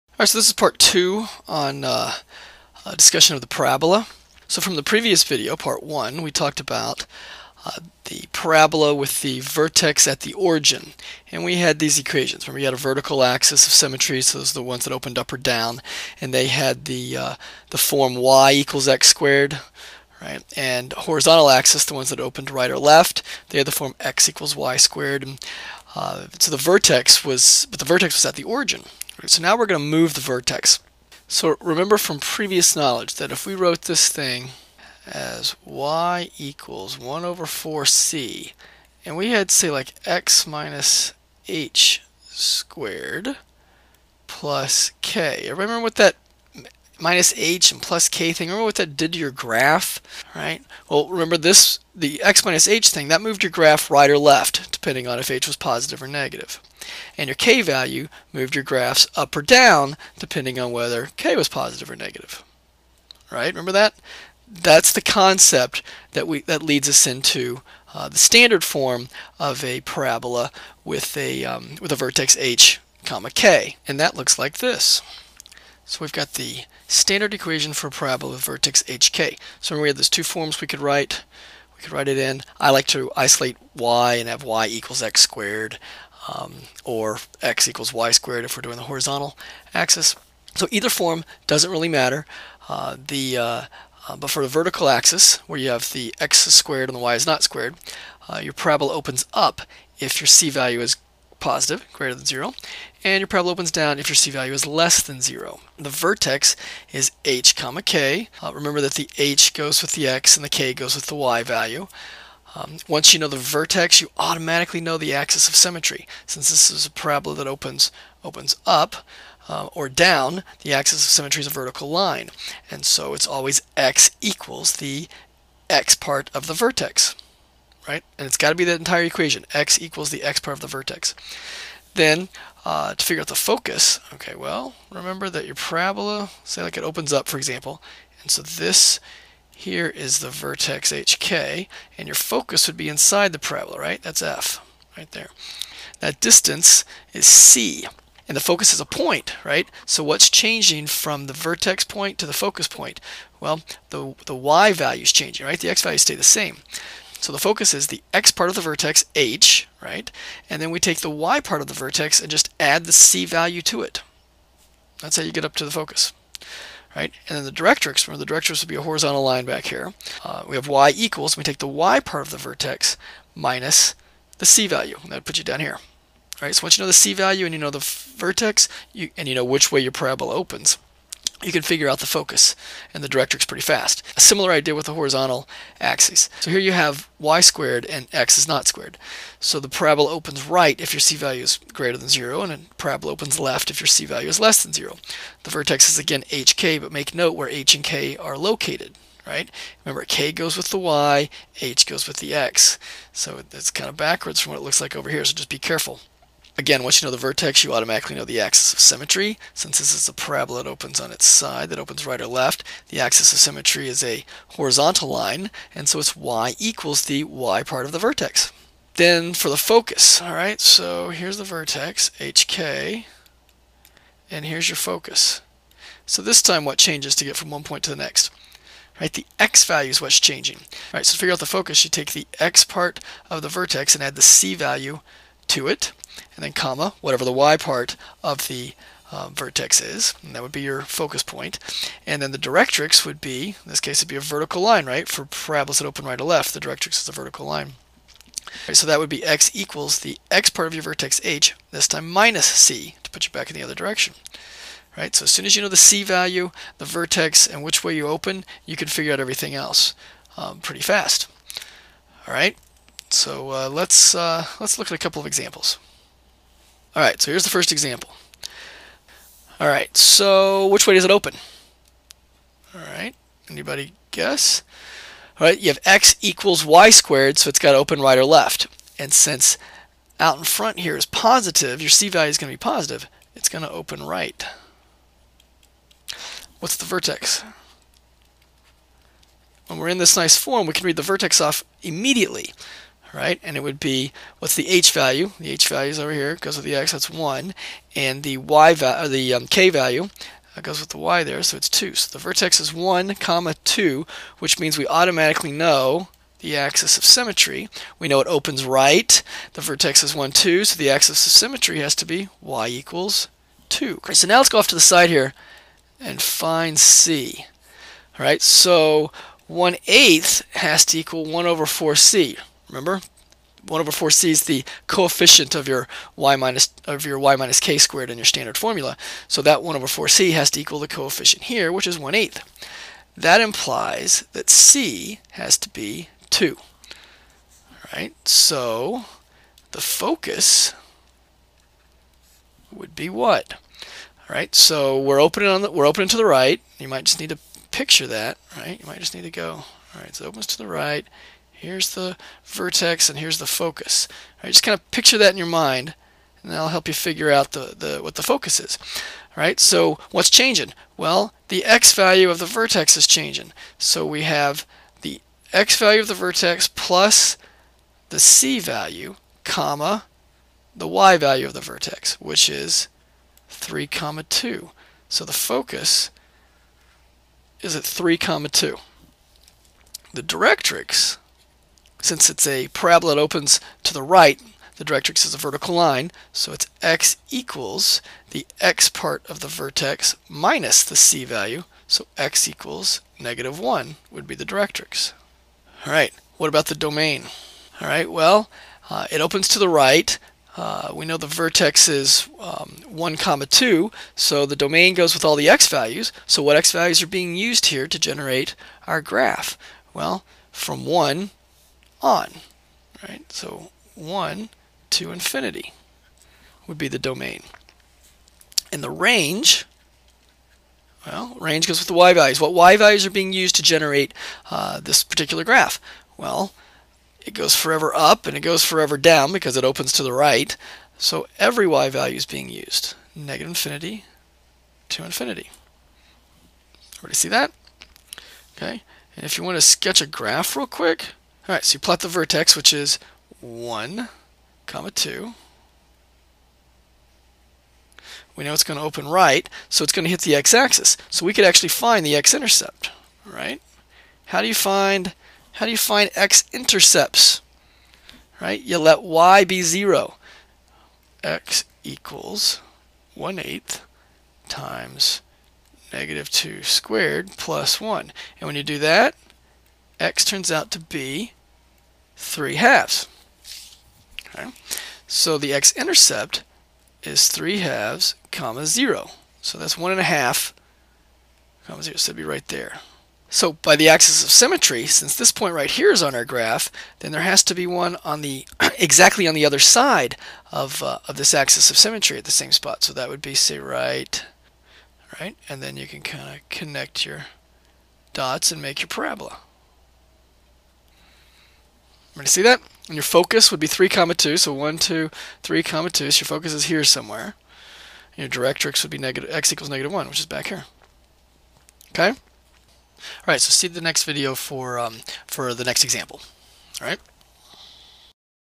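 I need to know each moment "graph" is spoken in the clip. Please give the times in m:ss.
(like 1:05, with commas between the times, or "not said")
0:49, 0:53, 0:58, 6:49, 7:05, 7:20, 8:06.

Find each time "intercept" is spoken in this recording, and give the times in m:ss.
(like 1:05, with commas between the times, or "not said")
7:32, 7:36, 7:55.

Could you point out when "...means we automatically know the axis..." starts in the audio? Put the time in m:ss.
5:04.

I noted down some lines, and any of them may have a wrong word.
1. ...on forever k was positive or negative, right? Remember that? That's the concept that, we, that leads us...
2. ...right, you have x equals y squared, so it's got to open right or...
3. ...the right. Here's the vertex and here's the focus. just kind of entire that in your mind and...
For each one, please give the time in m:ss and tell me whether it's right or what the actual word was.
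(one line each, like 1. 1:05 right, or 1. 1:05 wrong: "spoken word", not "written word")
1. 1:00 wrong: "whether", not "forever"
2. 4:35 right
3. 5:50 wrong: "picture", not "entire".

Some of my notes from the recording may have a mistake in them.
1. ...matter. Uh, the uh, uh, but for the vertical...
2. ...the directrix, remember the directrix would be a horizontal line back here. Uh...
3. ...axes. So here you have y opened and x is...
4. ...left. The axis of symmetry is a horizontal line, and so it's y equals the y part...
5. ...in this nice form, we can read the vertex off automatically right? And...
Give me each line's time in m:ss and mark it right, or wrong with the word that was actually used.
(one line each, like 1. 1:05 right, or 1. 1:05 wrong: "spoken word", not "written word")
1. 1:31 right
2. 2:47 right
3. 3:05 wrong: "squared", not "opened"
4. 3:32 right
5. 4:49 wrong: "immediately", not "automatically".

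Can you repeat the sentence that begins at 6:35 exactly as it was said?
All right, what about the domain?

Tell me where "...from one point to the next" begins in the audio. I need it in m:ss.
3:47.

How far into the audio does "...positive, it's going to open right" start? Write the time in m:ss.
4:42.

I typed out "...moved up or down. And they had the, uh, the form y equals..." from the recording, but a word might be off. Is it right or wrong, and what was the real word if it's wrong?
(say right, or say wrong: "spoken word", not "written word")
wrong: "opened", not "moved".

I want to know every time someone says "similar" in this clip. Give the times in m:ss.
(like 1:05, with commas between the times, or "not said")
3:04.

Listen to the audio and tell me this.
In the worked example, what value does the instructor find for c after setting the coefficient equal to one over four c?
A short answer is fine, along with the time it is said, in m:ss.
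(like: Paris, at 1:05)
2, at 5:34.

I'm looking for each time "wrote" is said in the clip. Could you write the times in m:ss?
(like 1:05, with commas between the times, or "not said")
0:33.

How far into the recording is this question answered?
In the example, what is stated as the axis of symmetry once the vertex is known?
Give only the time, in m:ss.
5:12.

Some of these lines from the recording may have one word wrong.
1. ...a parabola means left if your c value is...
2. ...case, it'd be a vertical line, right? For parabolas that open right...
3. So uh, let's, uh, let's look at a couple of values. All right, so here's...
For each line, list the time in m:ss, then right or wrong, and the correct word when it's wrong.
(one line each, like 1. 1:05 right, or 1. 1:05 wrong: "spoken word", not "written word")
1. 3:12 wrong: "opens", not "means"
2. 4:03 right
3. 4:23 wrong: "examples", not "values".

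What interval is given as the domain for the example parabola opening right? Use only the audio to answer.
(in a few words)
1 to infinity.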